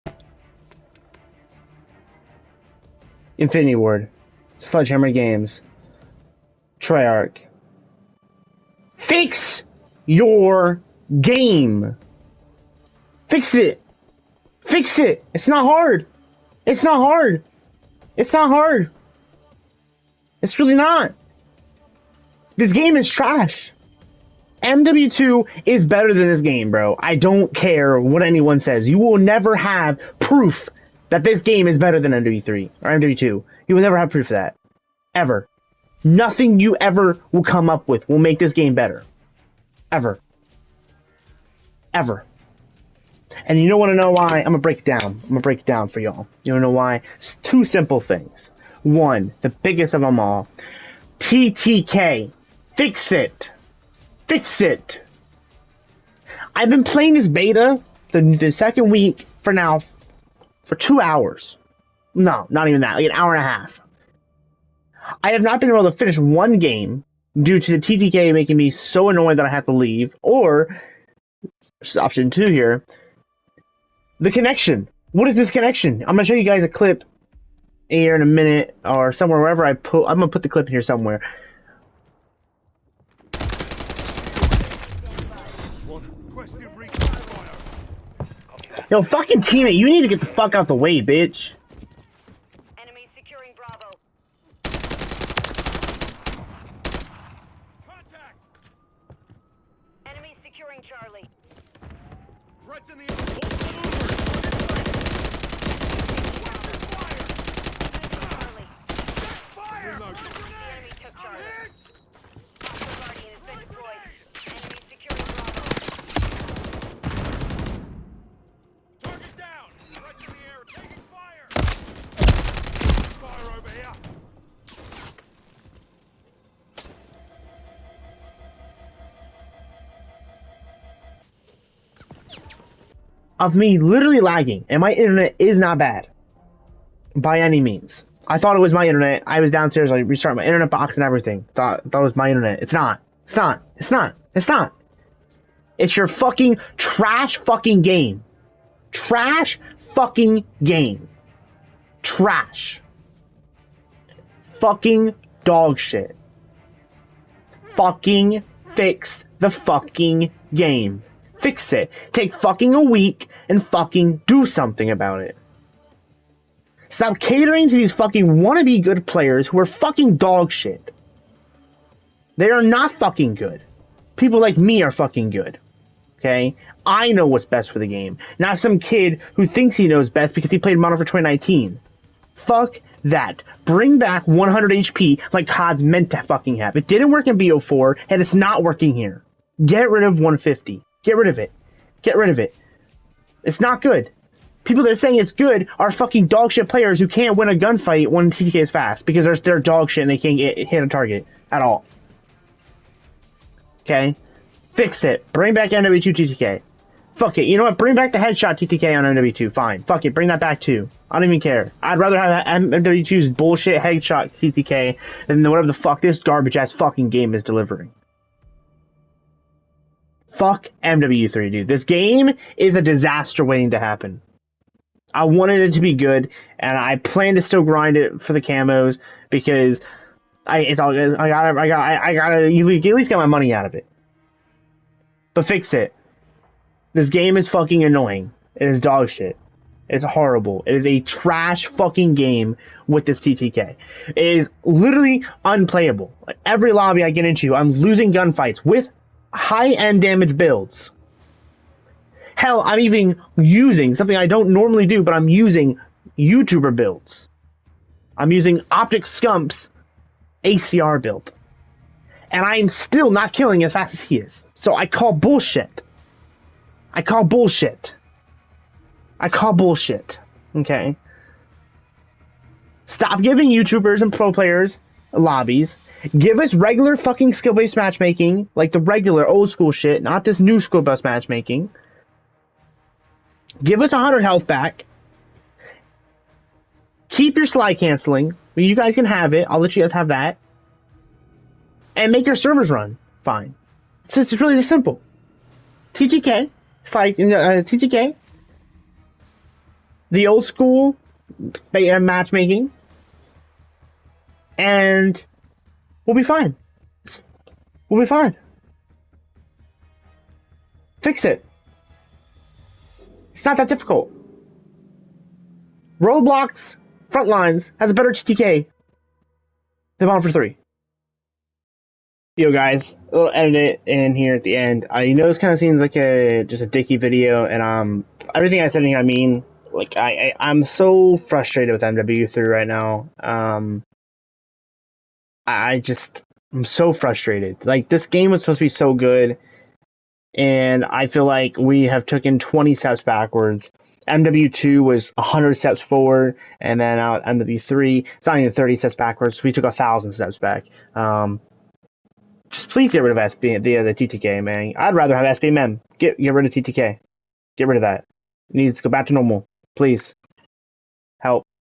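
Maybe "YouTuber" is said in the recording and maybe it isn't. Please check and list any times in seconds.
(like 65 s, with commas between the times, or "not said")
256 s, 273 s.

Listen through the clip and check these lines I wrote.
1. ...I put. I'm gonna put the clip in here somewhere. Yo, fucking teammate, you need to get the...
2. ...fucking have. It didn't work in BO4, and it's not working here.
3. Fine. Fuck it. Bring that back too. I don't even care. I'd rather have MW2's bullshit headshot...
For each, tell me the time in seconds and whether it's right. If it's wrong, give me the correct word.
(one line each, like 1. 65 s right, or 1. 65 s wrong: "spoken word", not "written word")
1. 79 s right
2. 186 s right
3. 209 s right.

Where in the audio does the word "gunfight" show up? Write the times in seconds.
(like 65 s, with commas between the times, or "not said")
197 s, 248 s.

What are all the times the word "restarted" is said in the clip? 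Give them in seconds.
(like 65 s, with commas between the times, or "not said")
139 s.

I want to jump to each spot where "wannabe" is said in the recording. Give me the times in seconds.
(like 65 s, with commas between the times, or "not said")
168 s.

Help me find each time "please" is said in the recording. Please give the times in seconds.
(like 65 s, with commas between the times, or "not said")
352 s, 359 s.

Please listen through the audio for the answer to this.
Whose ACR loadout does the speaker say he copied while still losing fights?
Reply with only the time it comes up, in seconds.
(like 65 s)
258 s.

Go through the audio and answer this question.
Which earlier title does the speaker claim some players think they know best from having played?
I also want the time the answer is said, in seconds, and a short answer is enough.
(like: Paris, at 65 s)
Modern Warfare 2019, at 180 s.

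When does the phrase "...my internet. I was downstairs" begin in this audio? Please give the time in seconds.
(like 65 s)
138 s.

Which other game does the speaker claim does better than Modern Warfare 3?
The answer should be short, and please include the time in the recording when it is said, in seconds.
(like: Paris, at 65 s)
Roblox Frontlines, at 316 s.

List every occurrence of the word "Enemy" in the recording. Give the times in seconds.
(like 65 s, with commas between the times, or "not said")
92 s, 100 s.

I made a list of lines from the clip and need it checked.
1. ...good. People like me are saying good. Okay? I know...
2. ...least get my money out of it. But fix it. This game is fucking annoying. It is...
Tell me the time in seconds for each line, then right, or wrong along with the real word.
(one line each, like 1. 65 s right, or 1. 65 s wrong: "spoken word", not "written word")
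1. 173 s wrong: "fucking", not "saying"
2. 232 s right.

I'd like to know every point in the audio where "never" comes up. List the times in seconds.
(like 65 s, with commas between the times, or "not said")
29 s, 33 s.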